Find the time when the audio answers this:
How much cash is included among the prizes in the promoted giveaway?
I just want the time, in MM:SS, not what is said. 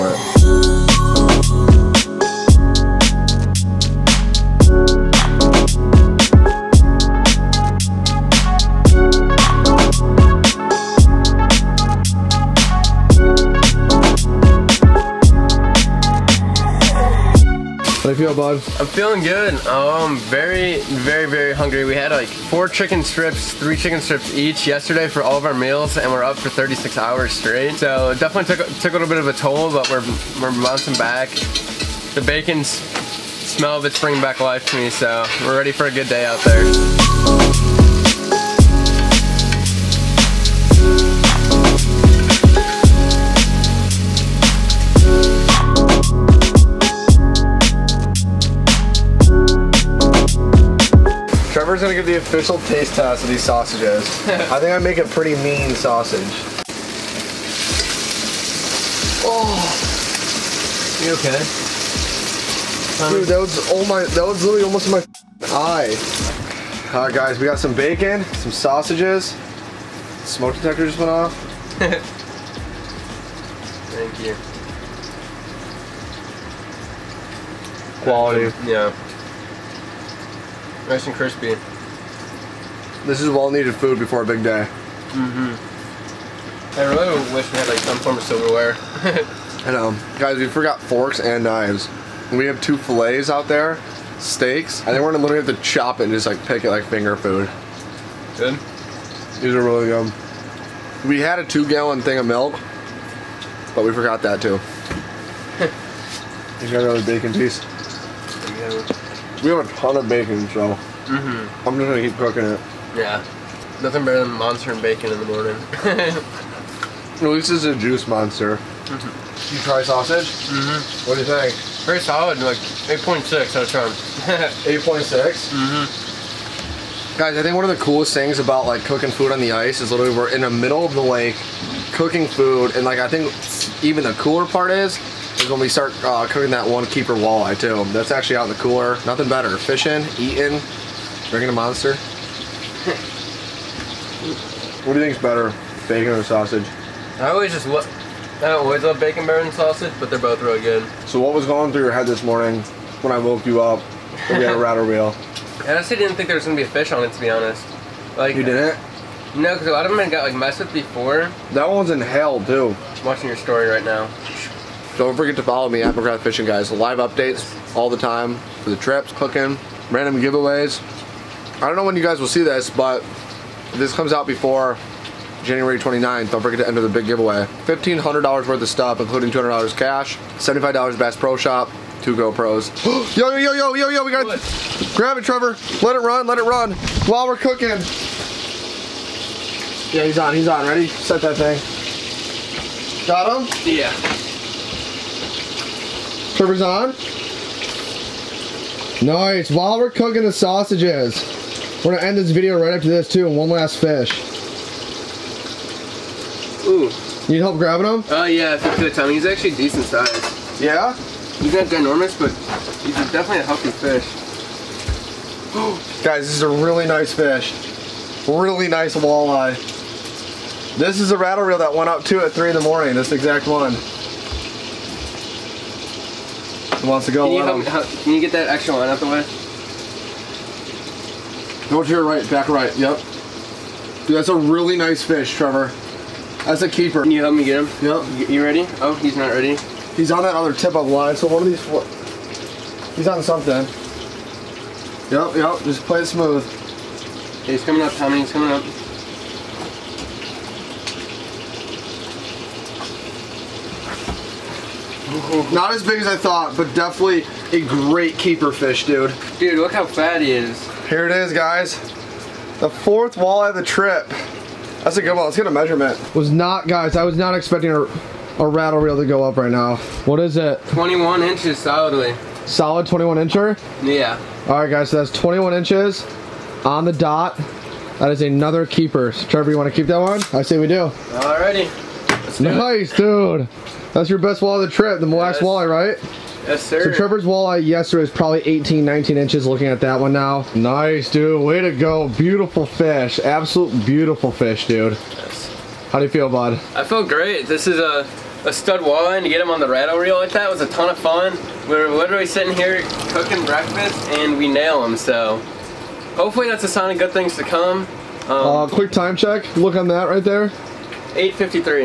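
02:59.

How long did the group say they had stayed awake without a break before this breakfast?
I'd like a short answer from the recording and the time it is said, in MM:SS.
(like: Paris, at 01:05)
36 hours, at 00:26.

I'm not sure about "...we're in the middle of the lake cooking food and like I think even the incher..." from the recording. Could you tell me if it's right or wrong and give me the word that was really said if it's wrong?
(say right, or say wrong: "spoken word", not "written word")
wrong: "cooler", not "incher".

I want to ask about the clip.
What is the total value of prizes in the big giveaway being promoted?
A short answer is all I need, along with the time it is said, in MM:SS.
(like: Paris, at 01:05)
$1,500, at 02:57.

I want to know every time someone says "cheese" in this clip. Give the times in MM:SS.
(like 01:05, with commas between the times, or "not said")
01:47.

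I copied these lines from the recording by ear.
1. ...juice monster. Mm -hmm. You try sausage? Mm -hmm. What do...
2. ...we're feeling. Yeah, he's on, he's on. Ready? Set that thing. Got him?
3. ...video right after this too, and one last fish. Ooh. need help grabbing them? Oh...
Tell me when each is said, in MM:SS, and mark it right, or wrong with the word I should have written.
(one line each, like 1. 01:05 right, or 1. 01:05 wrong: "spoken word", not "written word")
1. 01:57 right
2. 03:07 wrong: "cooking", not "feeling"
3. 03:22 right.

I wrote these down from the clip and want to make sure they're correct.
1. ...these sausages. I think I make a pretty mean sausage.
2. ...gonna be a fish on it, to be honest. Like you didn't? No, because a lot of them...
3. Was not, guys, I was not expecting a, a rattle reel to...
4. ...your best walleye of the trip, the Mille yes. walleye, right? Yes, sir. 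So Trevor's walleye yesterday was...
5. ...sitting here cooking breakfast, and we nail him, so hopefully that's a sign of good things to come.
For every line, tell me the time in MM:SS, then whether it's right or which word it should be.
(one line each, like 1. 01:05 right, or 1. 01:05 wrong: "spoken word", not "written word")
1. 00:53 right
2. 02:36 right
3. 04:26 right
4. 04:44 right
5. 05:02 right.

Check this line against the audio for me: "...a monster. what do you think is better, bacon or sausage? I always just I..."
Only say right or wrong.
right.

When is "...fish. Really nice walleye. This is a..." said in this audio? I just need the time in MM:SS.
03:37.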